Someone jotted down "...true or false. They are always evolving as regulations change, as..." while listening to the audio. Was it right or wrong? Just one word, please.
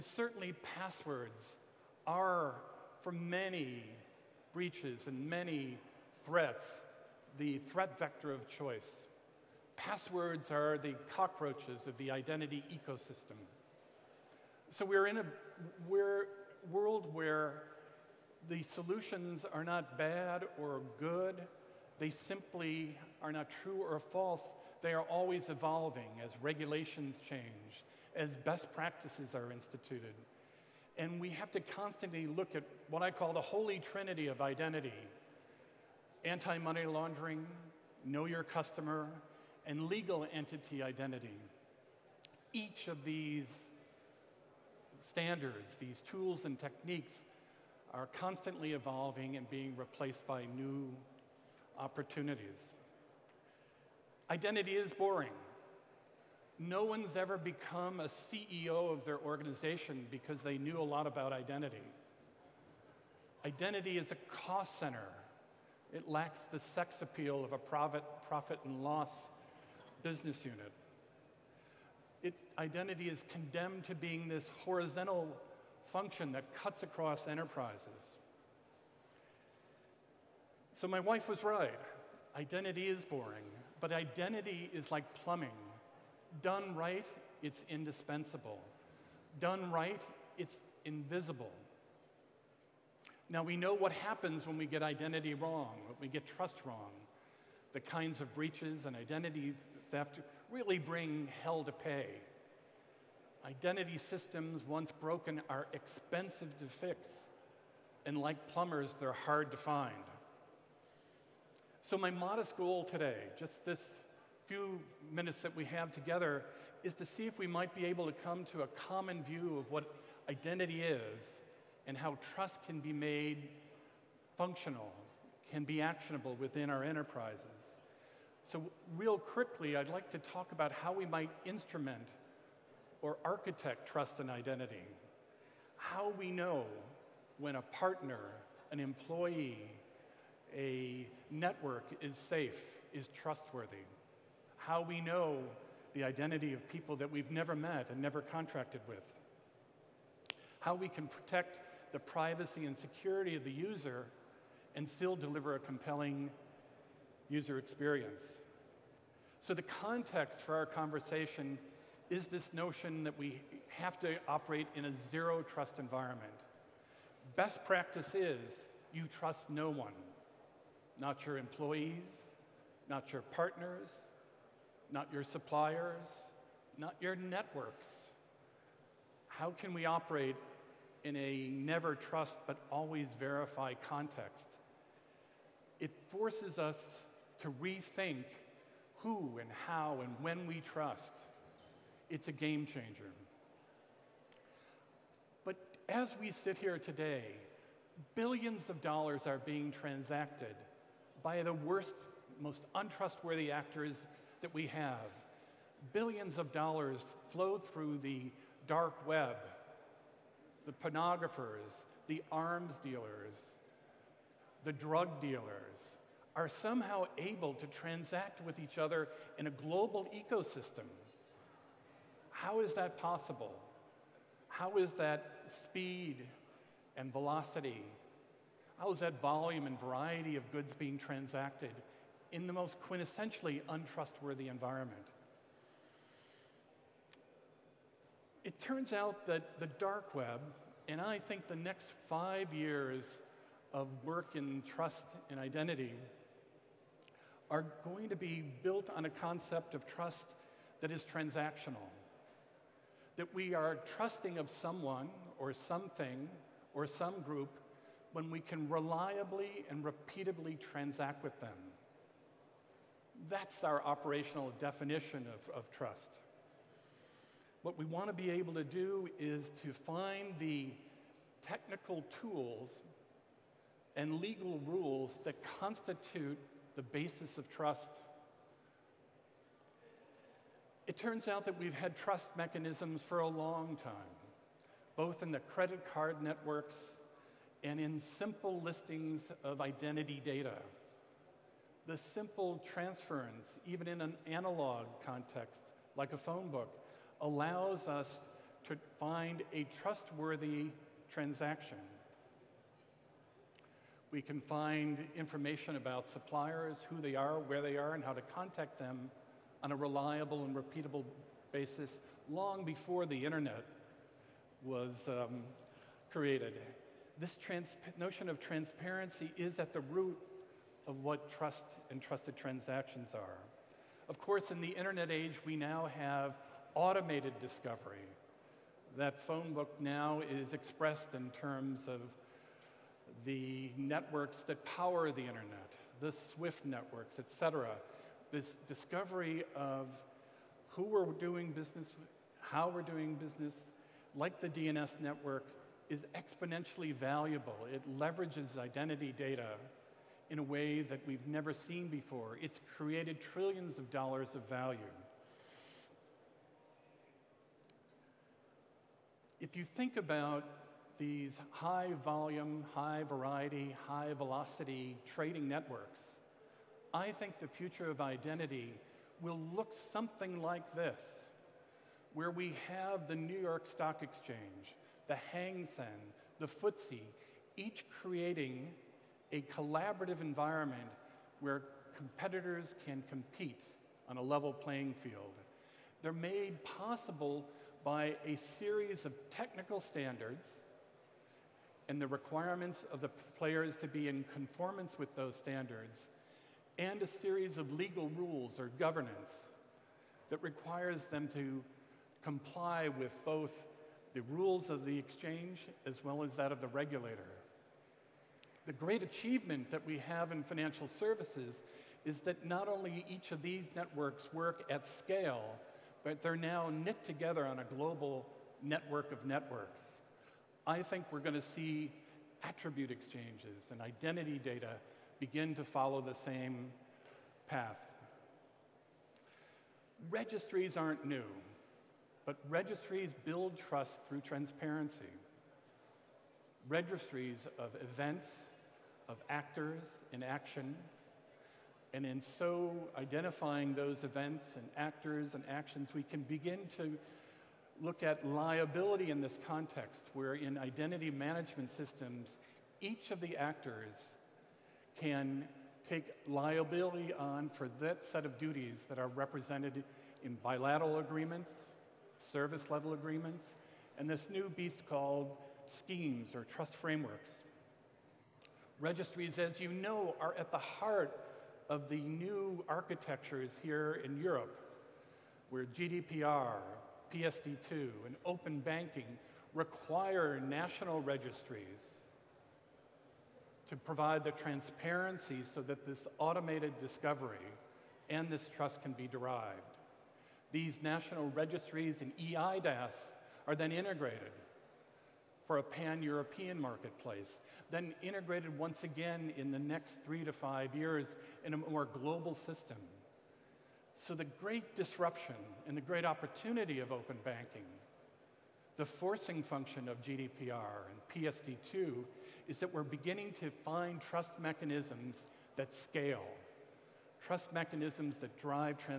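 right.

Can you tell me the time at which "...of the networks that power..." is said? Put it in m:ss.
5:31.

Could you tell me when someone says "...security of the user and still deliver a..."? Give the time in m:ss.
2:32.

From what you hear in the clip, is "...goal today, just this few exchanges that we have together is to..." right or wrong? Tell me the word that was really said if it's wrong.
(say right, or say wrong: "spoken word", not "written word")
wrong: "minutes", not "exchanges".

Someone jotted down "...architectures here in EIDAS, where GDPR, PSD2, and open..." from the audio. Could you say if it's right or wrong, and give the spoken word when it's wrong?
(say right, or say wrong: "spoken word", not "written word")
wrong: "Europe", not "EIDAS".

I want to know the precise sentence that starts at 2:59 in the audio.
How can we operate in a never trust but always verify context?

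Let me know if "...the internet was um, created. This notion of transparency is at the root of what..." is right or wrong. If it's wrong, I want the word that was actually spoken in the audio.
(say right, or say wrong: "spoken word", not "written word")
right.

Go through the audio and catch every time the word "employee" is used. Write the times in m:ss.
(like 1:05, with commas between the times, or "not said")
2:18, 2:51.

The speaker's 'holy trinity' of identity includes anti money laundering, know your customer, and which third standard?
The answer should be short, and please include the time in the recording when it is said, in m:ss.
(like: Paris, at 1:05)
Legal entity identity, at 0:39.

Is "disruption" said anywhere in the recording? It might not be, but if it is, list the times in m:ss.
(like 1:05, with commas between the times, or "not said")
8:24.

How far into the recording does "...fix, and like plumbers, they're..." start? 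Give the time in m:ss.
1:46.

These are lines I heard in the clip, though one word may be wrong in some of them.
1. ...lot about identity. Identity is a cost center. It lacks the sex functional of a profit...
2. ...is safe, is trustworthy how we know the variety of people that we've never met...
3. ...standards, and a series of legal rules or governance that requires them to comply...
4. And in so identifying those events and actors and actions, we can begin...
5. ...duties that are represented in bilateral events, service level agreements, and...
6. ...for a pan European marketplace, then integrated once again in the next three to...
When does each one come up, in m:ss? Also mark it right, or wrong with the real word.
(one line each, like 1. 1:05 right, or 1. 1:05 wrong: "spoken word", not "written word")
1. 1:00 wrong: "appeal", not "functional"
2. 2:22 wrong: "identity", not "variety"
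3. 6:35 right
4. 7:21 right
5. 7:38 wrong: "agreements", not "events"
6. 8:15 right.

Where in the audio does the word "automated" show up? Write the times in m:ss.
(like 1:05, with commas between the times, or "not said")
5:26, 8:06.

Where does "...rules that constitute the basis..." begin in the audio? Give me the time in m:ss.
4:34.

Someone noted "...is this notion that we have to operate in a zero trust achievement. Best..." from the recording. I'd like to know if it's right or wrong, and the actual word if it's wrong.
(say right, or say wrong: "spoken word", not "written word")
wrong: "environment", not "achievement".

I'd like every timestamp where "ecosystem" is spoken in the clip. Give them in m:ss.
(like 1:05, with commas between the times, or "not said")
0:12, 3:40.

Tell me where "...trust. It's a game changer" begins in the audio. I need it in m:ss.
3:10.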